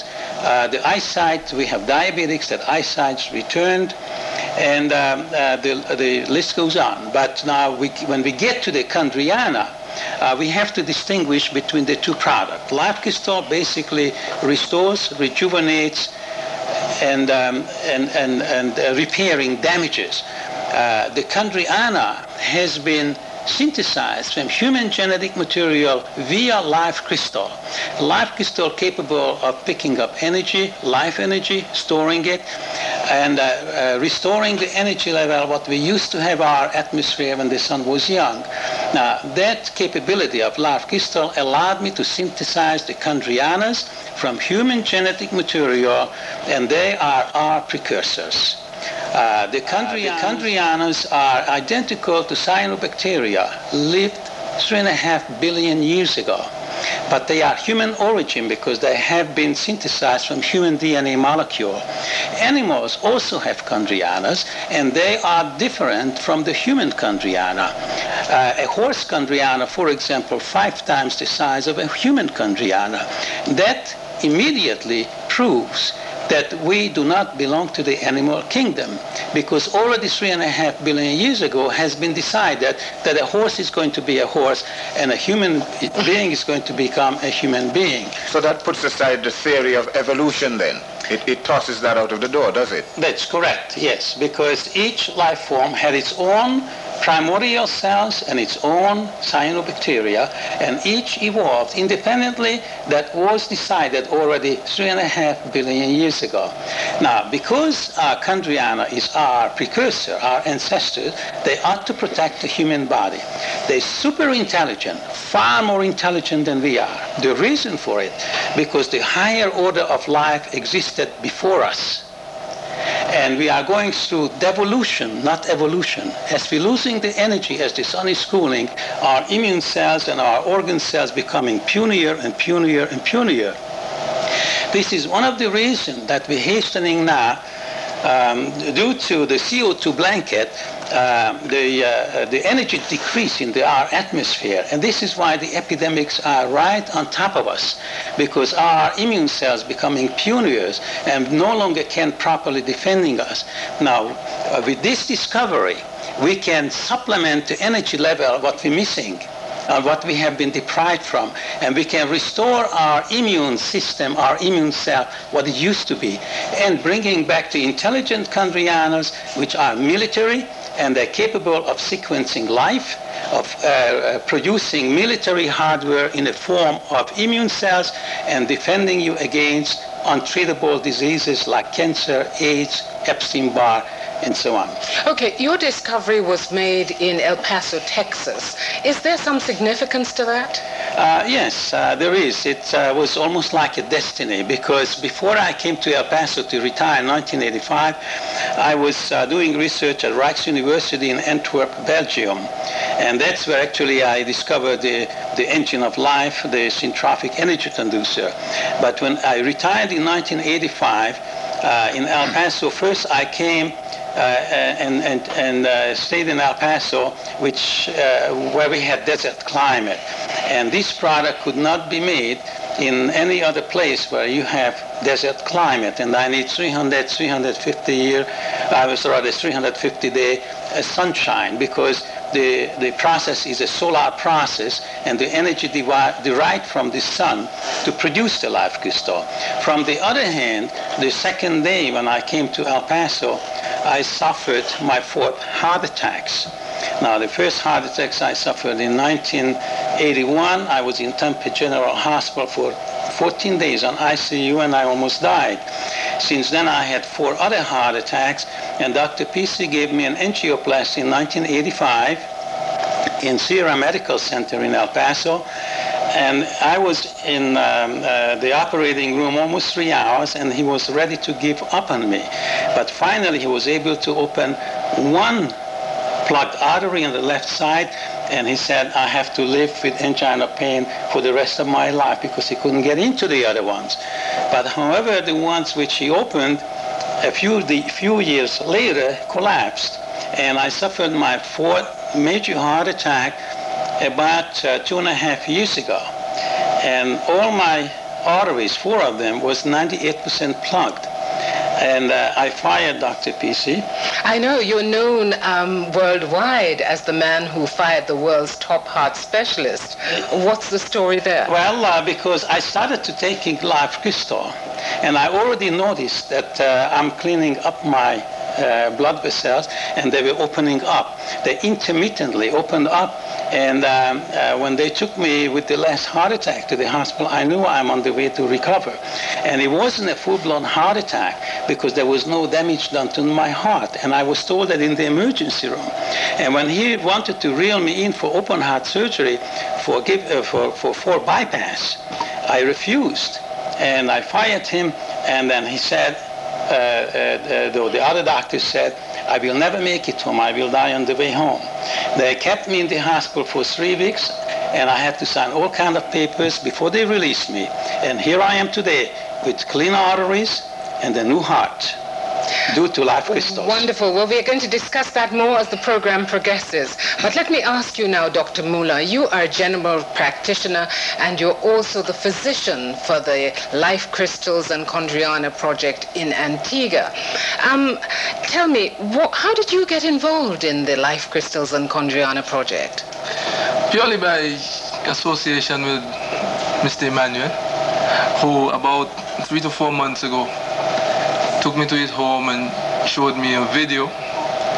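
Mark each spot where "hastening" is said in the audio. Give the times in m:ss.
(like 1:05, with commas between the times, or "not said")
2:16.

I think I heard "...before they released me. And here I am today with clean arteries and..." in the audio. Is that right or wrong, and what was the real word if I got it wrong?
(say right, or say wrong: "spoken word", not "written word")
right.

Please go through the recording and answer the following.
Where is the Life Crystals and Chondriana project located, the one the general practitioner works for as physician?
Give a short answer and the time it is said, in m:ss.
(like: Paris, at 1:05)
Antigua, at 6:16.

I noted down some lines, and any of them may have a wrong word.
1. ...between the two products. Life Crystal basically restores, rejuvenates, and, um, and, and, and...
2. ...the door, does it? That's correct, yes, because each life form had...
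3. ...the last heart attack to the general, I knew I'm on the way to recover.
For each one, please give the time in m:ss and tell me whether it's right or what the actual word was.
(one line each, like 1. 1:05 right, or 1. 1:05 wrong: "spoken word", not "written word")
1. 0:11 right
2. 1:32 right
3. 5:25 wrong: "hospital", not "general".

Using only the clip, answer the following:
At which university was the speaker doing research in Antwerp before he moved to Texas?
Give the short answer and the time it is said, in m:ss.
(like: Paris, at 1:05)
Rijks University, at 3:20.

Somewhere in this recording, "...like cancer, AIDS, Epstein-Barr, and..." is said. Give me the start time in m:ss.
3:01.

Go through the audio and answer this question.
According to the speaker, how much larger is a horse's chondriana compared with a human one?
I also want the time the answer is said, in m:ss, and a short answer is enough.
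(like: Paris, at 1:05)
5 times, at 1:10.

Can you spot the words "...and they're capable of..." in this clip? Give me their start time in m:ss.
2:50.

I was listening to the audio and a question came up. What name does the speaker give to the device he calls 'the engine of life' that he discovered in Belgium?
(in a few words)
syntrophic energy conducer.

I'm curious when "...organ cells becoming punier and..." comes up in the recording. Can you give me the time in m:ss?
2:10.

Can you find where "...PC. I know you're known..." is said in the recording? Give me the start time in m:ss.
5:03.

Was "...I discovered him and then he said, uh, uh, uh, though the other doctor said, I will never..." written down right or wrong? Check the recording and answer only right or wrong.
wrong.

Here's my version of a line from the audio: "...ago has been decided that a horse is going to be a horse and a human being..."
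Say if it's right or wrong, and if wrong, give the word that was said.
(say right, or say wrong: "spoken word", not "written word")
right.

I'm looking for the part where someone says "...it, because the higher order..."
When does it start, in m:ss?
1:58.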